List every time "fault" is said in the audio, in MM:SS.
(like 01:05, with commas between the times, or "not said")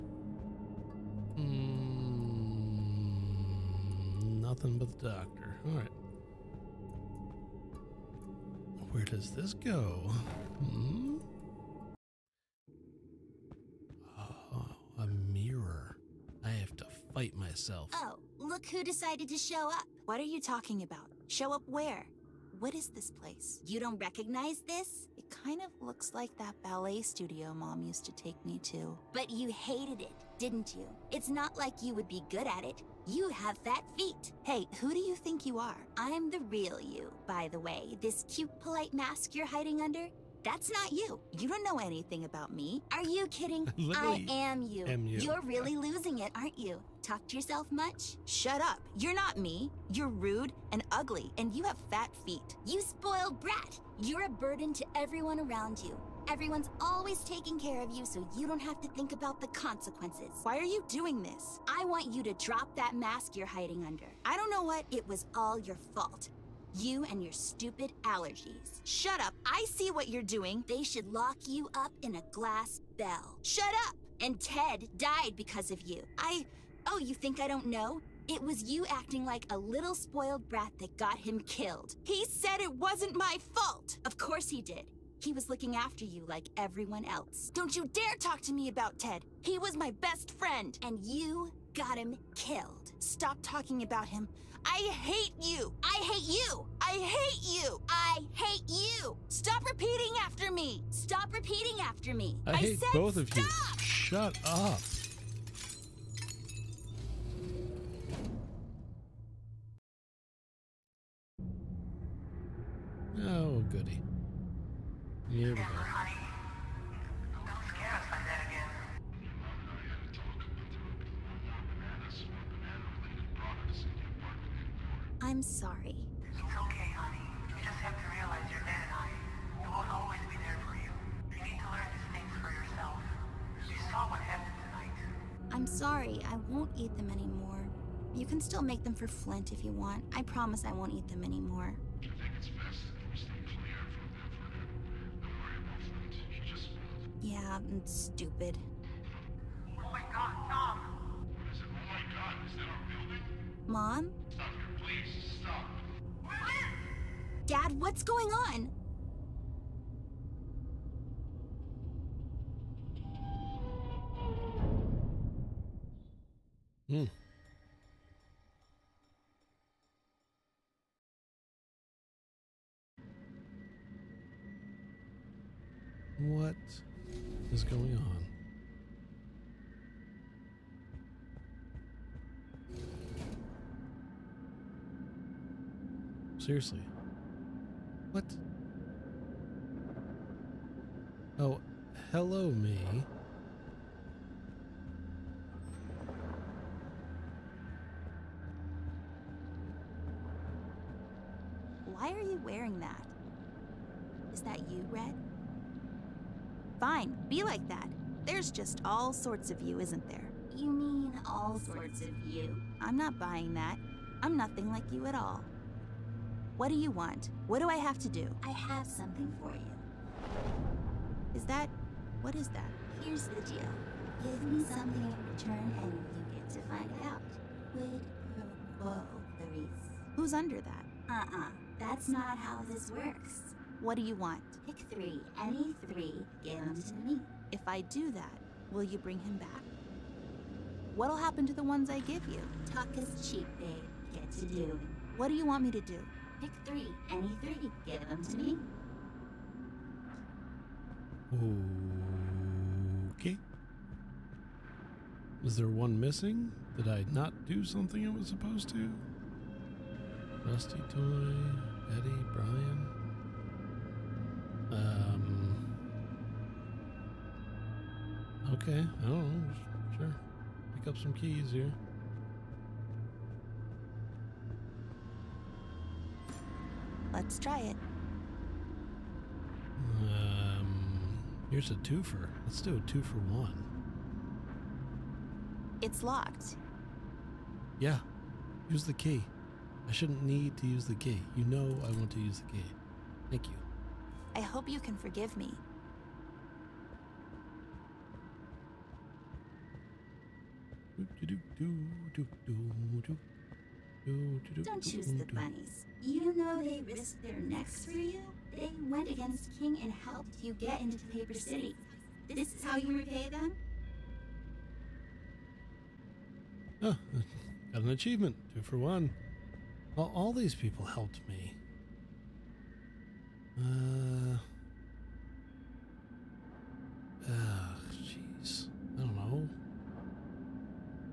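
01:05, 01:23.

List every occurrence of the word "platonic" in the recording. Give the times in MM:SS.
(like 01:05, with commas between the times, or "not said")
not said.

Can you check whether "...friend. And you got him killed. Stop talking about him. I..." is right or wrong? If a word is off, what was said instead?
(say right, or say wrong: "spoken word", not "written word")
right.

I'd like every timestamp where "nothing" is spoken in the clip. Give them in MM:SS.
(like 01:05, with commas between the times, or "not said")
00:04, 03:34.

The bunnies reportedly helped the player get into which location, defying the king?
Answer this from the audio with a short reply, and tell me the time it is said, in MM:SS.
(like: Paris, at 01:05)
Paper City, at 05:11.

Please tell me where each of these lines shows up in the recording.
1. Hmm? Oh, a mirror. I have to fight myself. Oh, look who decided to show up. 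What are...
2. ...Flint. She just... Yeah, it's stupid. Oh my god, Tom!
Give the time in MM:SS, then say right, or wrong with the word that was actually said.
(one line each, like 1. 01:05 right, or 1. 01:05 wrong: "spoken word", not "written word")
1. 00:10 right
2. 02:25 right.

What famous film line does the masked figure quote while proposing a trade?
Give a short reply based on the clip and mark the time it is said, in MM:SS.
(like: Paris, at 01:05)
Quid pro quo, Clarice, at 03:47.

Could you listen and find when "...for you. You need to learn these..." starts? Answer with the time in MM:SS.
02:10.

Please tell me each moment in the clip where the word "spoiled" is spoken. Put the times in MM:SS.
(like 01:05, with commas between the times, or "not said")
00:52, 01:19.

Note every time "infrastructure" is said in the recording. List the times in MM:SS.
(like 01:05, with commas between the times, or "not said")
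not said.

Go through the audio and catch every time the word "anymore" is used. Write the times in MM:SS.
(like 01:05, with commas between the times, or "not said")
02:17, 02:21.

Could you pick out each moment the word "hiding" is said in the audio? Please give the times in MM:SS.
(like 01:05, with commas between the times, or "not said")
00:39, 01:03.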